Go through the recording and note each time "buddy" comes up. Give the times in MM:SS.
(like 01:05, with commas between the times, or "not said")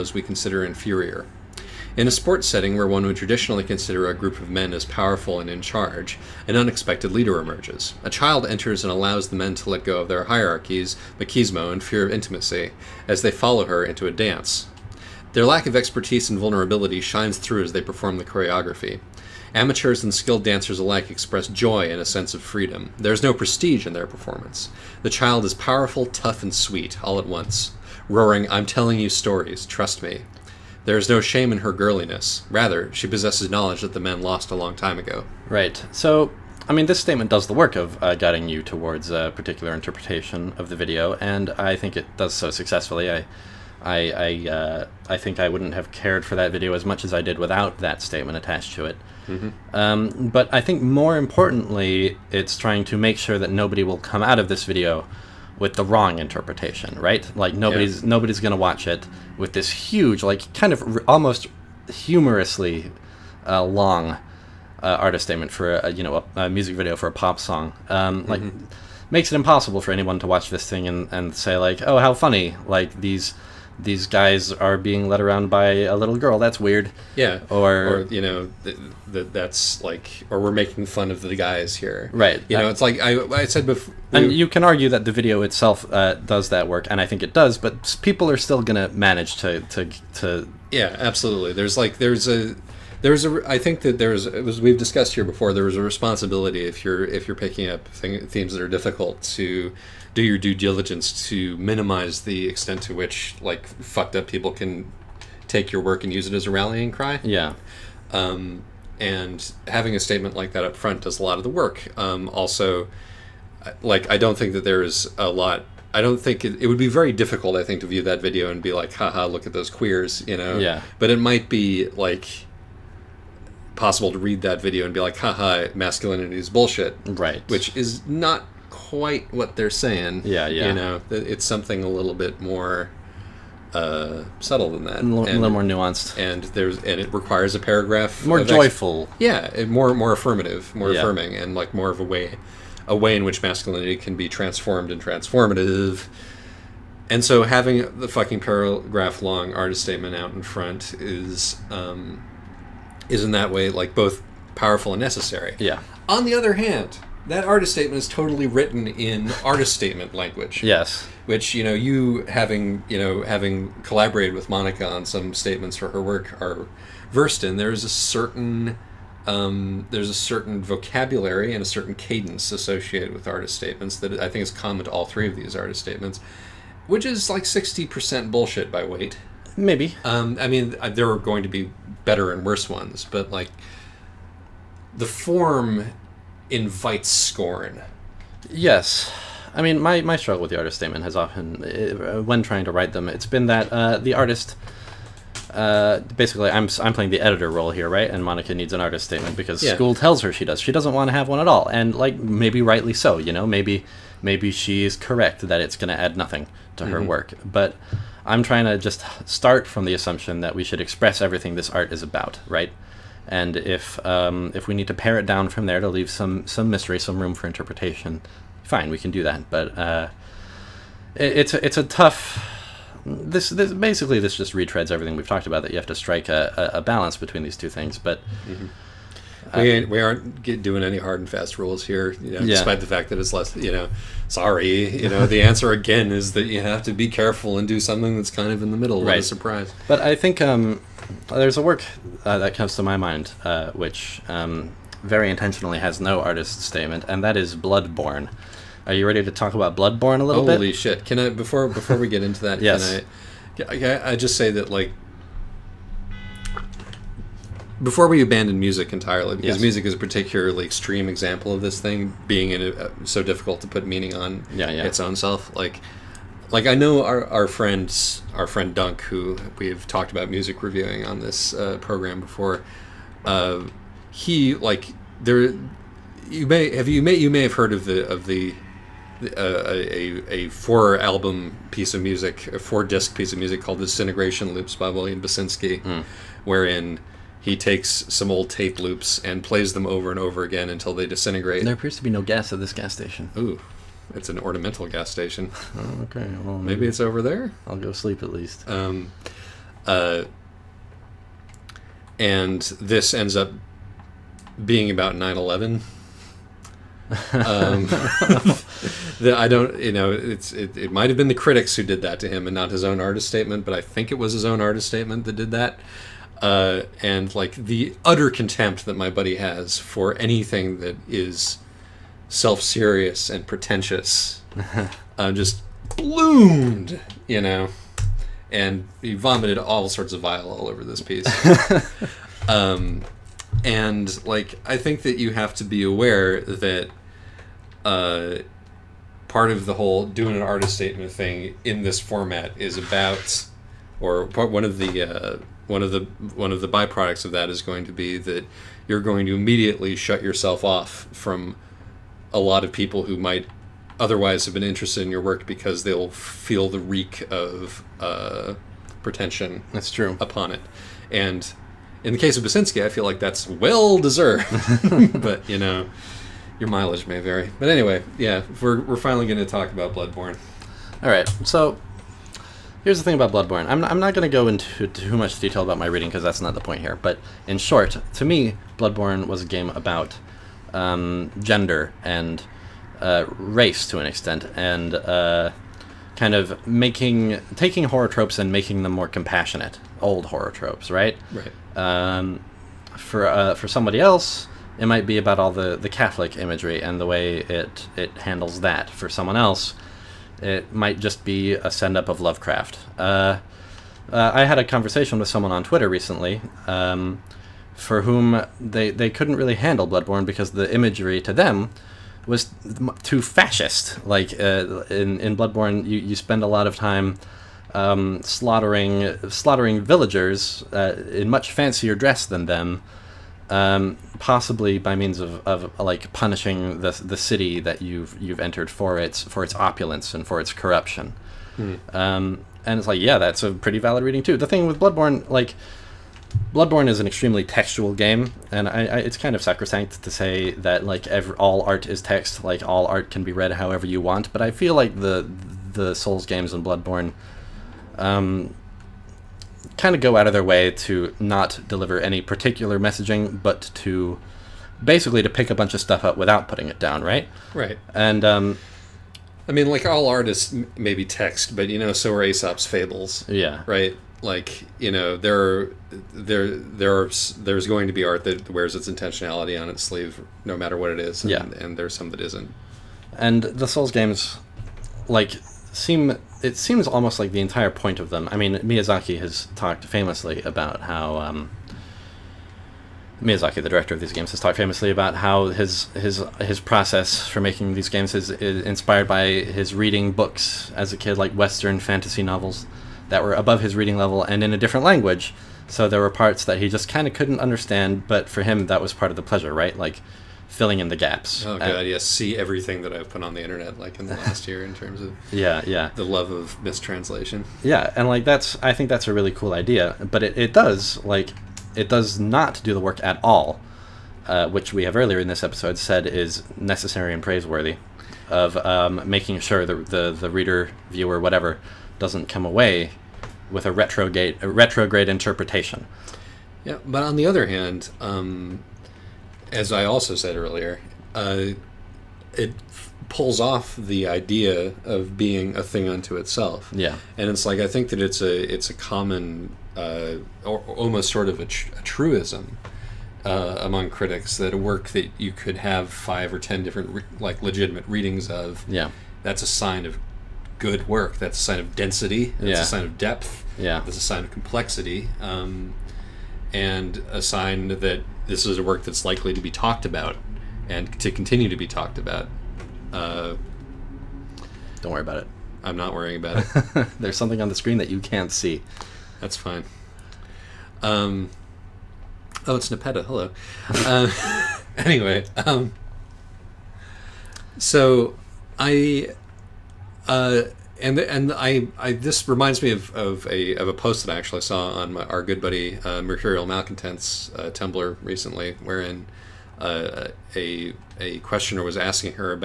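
05:19, 09:45.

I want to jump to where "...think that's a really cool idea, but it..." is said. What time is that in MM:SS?
08:28.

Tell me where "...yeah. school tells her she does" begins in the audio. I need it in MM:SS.
03:19.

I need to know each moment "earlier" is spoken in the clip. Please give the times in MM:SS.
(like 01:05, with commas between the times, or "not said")
08:34, 08:50.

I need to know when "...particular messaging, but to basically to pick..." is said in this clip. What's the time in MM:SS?
07:32.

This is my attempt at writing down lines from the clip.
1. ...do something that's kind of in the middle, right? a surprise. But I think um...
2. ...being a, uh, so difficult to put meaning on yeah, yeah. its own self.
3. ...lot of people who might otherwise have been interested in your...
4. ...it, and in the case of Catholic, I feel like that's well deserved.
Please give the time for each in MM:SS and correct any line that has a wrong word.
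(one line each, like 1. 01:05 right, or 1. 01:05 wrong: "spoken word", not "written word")
1. 03:57 right
2. 04:22 right
3. 05:52 right
4. 06:00 wrong: "Basinski", not "Catholic".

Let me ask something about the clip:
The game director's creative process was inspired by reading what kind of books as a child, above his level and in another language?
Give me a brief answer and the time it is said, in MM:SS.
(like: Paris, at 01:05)
Western fantasy novels, at 08:11.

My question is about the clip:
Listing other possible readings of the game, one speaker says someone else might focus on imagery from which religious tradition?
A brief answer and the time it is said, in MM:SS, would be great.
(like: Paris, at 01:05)
Catholic, at 06:35.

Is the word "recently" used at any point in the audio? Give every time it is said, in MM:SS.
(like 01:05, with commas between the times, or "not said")
06:45, 09:48.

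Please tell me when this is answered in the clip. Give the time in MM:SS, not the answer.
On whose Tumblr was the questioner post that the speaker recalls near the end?
09:46.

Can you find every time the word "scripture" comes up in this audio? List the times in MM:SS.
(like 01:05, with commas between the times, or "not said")
not said.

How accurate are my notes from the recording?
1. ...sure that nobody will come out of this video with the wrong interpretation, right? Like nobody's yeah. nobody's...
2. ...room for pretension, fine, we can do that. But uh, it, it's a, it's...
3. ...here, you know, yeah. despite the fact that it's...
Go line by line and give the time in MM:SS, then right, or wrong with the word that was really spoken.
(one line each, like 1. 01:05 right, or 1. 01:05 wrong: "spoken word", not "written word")
1. 00:53 right
2. 03:37 wrong: "interpretation", not "pretension"
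3. 03:51 right.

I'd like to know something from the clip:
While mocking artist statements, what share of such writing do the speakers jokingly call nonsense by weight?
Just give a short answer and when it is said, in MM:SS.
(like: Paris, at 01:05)
60%, at 02:57.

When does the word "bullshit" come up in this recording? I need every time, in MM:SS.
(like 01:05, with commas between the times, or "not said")
02:06, 02:58.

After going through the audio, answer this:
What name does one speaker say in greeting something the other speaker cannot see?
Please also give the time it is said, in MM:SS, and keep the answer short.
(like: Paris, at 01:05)
Nepeta, at 09:32.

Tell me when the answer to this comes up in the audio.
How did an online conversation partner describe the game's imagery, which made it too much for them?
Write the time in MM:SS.
06:53.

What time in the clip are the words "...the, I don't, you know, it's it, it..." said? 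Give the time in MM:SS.
05:09.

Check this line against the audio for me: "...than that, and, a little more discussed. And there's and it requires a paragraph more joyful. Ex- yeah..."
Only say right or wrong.
wrong.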